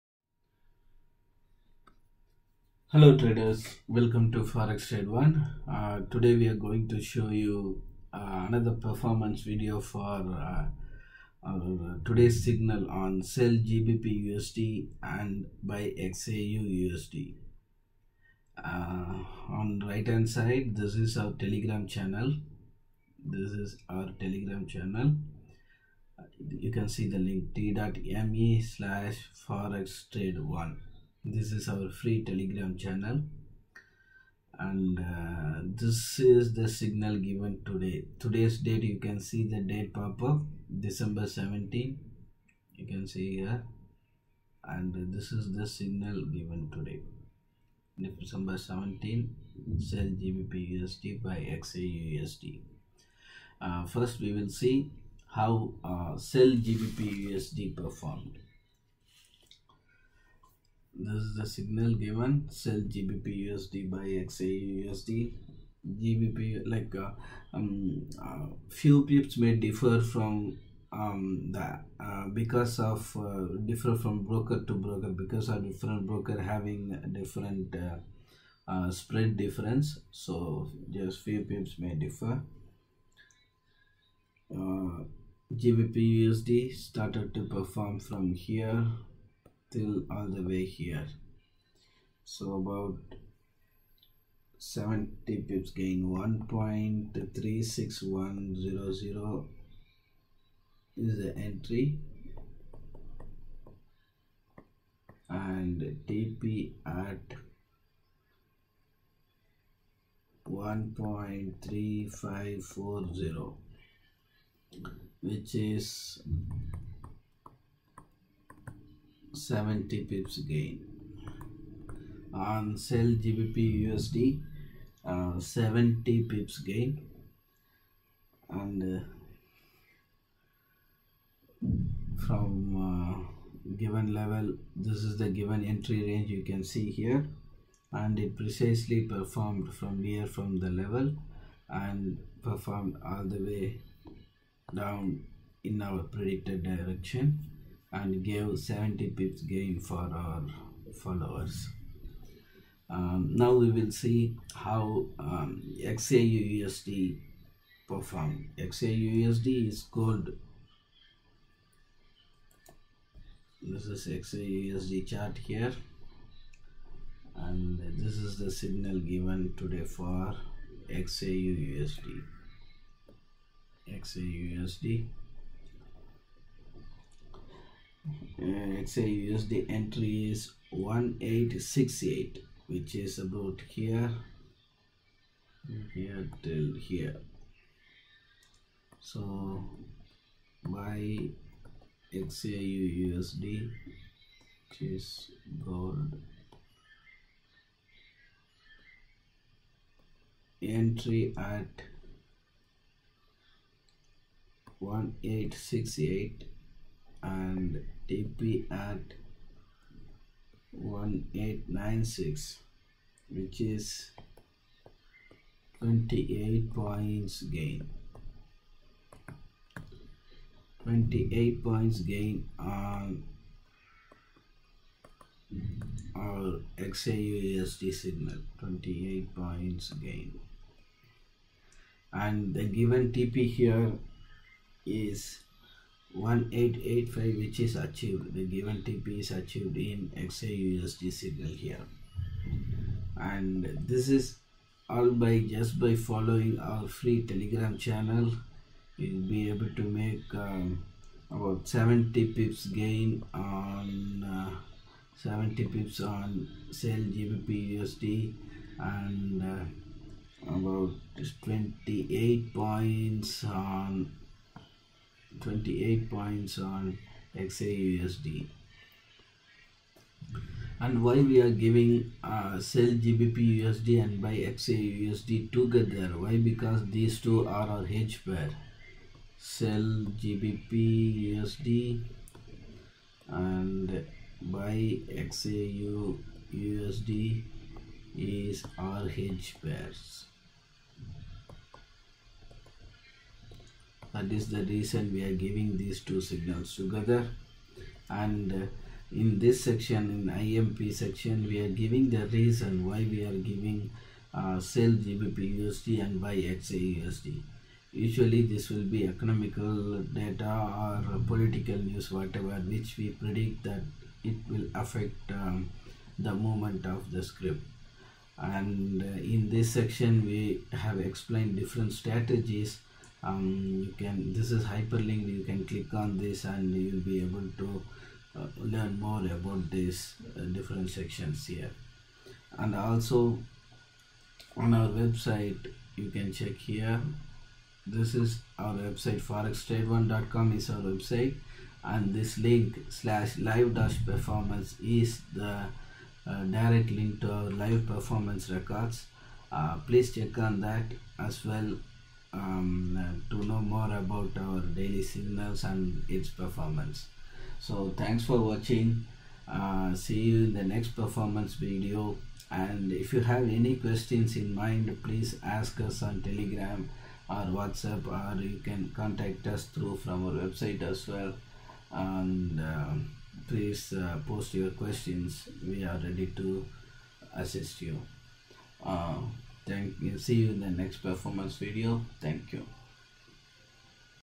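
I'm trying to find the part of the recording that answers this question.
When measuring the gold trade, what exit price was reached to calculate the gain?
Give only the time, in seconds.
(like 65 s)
208 s.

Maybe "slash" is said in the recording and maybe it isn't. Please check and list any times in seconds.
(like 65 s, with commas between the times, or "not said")
28 s, 342 s.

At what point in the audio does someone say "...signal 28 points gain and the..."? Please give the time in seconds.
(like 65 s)
227 s.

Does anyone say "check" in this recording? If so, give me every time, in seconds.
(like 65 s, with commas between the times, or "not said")
336 s, 350 s.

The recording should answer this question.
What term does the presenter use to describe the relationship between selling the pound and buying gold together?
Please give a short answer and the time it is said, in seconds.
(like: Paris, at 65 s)
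hedge pair, at 277 s.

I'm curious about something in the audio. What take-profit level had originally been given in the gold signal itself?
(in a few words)
1885.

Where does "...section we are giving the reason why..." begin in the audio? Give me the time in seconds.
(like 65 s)
300 s.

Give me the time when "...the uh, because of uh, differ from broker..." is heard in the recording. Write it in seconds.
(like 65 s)
71 s.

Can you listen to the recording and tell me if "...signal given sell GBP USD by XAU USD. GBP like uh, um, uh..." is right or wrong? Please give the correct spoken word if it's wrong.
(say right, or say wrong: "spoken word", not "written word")
right.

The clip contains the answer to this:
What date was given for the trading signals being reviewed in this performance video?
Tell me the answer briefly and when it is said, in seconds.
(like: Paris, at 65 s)
December 17, at 40 s.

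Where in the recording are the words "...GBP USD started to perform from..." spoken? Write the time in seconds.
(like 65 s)
85 s.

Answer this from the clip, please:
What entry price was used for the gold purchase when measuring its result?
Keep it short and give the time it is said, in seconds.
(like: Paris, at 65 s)
1868, at 180 s.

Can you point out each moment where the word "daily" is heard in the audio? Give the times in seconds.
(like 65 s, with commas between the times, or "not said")
354 s.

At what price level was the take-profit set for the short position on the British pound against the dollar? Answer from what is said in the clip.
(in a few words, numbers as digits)
1.3540.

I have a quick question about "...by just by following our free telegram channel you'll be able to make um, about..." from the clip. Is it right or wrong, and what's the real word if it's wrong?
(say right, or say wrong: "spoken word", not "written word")
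right.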